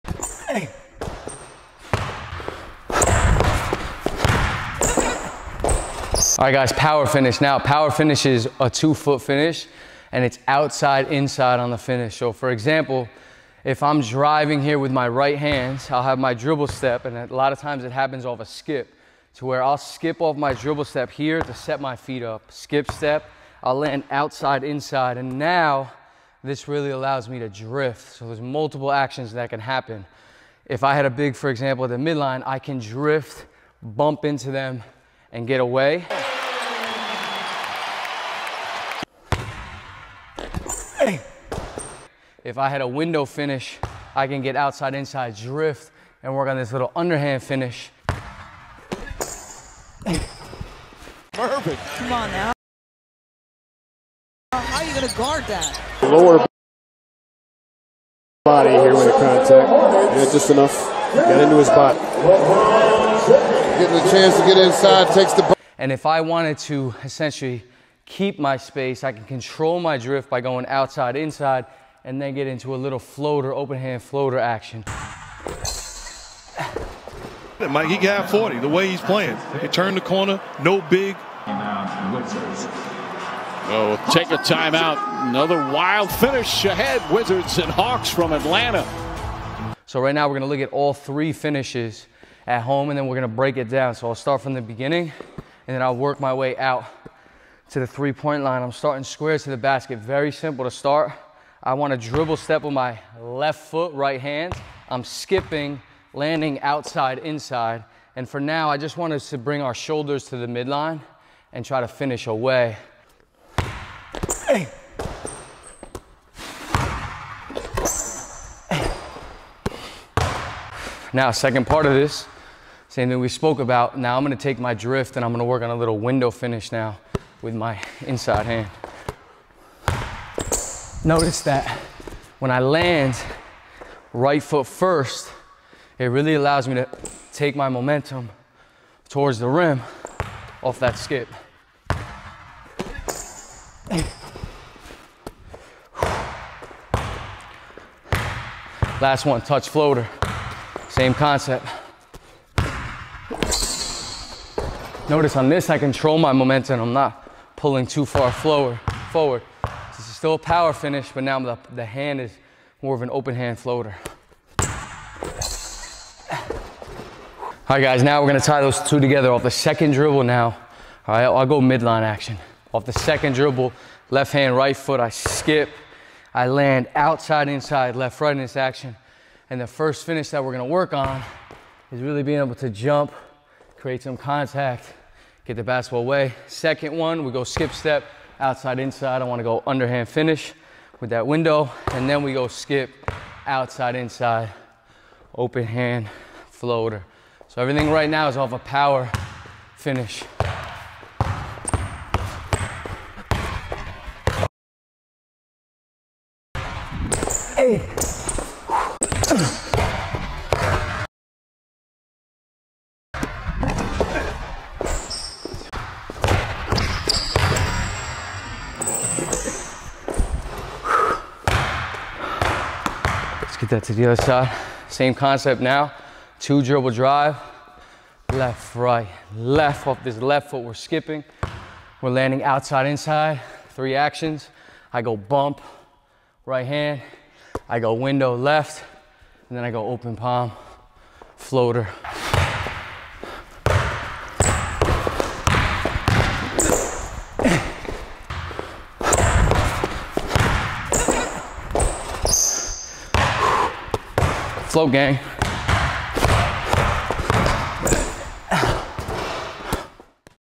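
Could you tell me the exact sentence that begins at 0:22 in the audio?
Skip step, I'll land outside inside and now this really allows me to drift.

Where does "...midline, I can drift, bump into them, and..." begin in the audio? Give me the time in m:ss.
0:31.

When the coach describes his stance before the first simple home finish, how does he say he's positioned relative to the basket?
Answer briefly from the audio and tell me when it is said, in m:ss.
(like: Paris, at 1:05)
Square to the basket, at 1:39.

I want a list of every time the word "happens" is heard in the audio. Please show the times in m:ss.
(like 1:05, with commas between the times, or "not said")
0:17, 0:29.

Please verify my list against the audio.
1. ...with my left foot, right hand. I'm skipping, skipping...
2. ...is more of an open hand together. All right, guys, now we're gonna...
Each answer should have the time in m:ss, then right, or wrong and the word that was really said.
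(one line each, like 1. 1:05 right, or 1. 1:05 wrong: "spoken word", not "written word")
1. 1:42 wrong: "landing", not "skipping"
2. 2:42 wrong: "floater", not "together".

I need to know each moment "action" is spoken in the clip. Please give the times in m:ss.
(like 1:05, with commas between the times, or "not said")
0:28, 1:14, 2:52, 2:58, 3:53.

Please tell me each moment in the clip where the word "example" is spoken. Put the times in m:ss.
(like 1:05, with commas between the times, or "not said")
0:12, 0:31.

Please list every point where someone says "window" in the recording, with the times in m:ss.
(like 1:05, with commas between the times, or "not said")
0:42, 2:05, 3:11, 3:57.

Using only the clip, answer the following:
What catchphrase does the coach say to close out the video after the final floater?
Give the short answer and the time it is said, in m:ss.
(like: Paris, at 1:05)
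Float gang, at 4:14.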